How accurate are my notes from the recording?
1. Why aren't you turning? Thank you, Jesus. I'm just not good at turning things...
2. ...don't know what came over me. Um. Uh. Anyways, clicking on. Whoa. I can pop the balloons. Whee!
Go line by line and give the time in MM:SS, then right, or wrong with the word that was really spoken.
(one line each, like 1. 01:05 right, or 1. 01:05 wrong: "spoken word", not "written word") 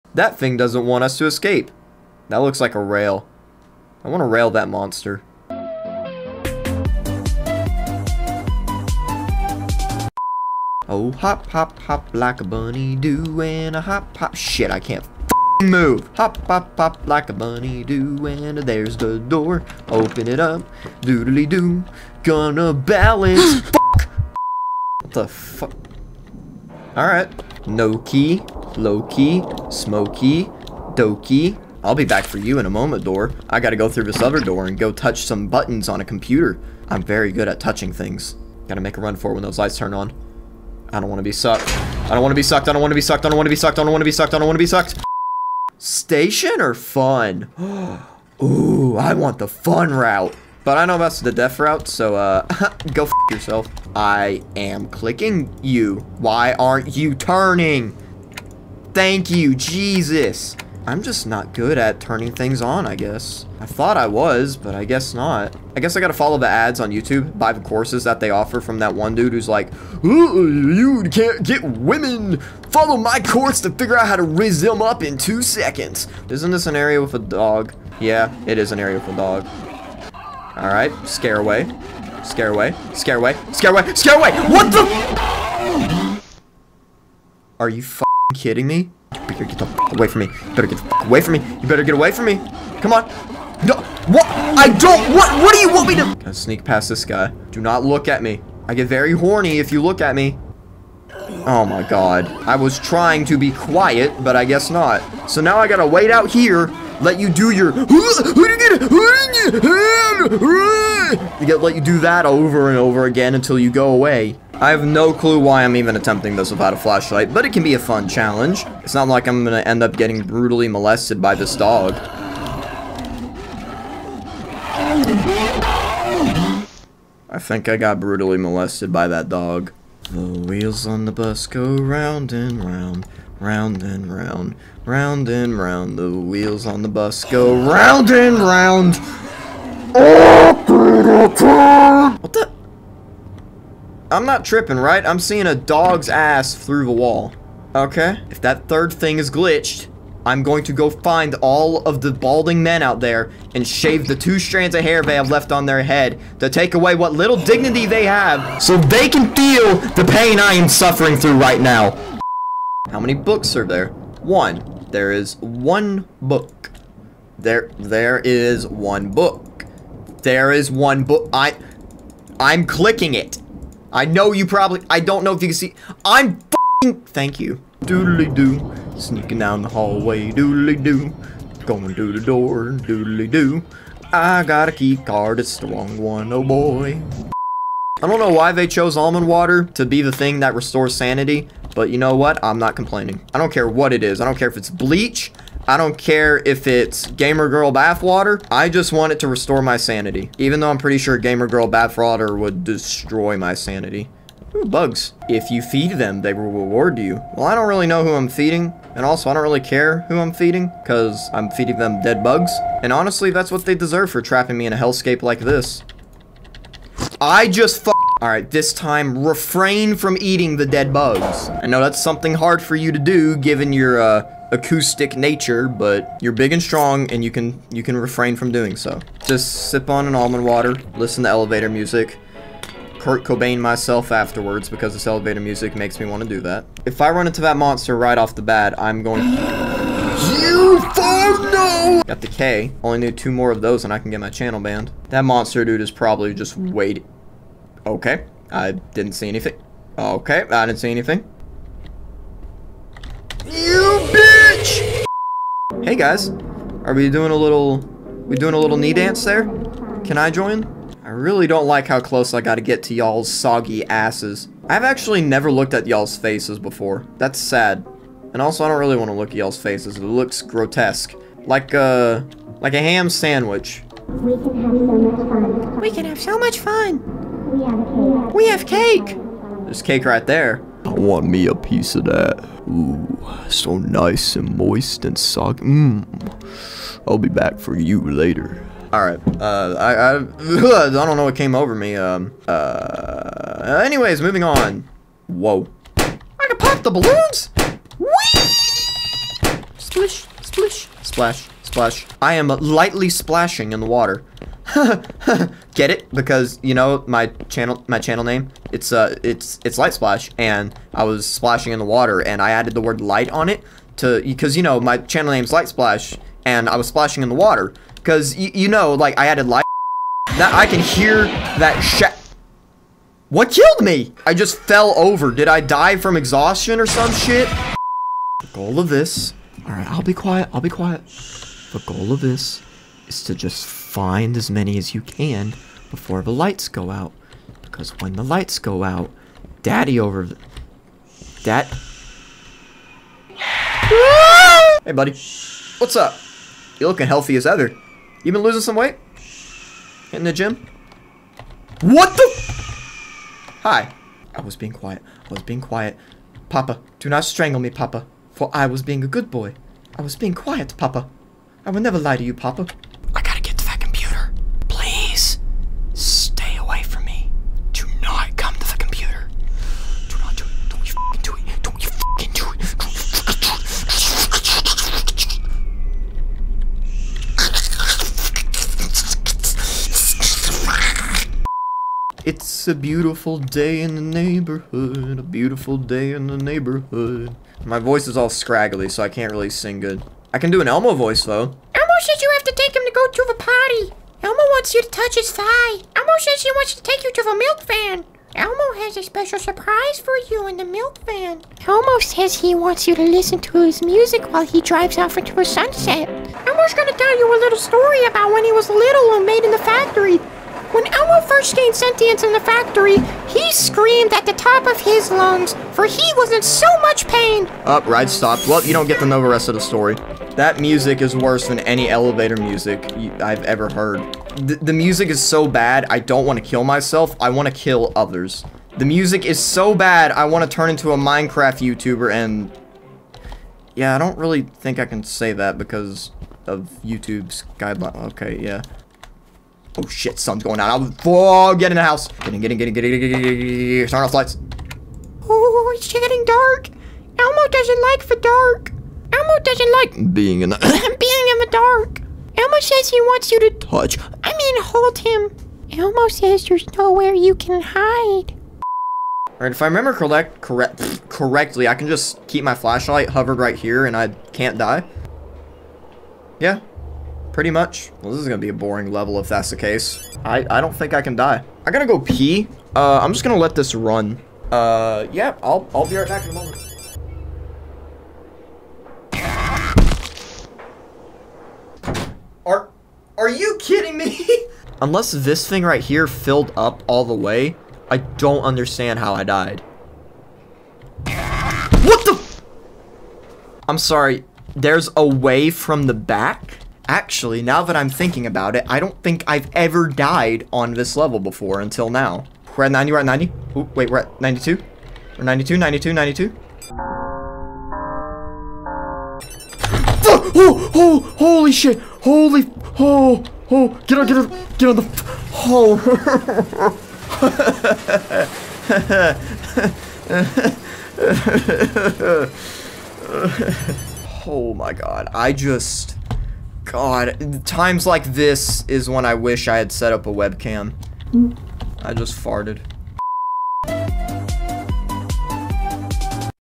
1. 00:56 right
2. 04:51 wrong: "moving", not "clicking".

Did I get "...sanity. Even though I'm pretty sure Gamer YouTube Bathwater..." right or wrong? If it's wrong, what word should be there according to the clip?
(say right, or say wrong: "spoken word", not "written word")
wrong: "Girl", not "YouTube".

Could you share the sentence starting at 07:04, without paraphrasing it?
The, the music is so bad, I don't want to kill myself.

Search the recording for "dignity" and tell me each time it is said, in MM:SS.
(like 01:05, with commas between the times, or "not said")
02:37.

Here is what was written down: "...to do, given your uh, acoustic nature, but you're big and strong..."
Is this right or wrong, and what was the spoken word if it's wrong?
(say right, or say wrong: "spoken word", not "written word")
right.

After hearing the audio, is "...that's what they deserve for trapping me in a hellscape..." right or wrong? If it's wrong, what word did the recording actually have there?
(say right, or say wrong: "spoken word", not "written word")
right.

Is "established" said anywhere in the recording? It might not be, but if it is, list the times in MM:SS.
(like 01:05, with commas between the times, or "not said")
not said.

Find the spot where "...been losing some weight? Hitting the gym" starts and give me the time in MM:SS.
05:48.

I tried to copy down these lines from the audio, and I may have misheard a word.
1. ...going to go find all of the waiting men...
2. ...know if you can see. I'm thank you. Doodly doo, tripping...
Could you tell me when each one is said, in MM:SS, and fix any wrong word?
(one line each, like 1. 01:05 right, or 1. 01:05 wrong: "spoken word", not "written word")
1. 02:30 wrong: "balding", not "waiting"
2. 02:55 wrong: "sneaking", not "tripping".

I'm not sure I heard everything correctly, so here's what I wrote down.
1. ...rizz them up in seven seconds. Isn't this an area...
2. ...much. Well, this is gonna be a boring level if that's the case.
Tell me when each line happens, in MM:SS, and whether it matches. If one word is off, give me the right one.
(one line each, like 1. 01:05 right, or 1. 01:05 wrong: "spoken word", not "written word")
1. 01:14 wrong: "two", not "seven"
2. 07:47 right.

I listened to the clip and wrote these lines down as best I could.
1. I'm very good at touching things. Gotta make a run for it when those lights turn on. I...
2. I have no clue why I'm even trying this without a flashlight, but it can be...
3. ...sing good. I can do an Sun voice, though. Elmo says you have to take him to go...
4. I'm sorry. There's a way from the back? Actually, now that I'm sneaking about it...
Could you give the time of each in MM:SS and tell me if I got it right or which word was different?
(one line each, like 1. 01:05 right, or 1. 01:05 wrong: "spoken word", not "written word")
1. 00:36 right
2. 01:54 wrong: "attempting", not "trying"
3. 06:29 wrong: "Elmo", not "Sun"
4. 08:13 wrong: "thinking", not "sneaking".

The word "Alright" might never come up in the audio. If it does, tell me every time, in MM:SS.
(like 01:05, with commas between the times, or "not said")
00:26, 01:20.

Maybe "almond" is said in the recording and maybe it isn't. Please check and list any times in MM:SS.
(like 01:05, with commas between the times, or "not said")
03:08, 03:50.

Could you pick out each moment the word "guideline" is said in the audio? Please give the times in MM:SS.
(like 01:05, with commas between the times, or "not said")
07:17.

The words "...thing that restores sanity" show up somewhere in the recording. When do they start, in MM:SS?
03:10.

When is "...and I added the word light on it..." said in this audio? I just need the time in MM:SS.
05:12.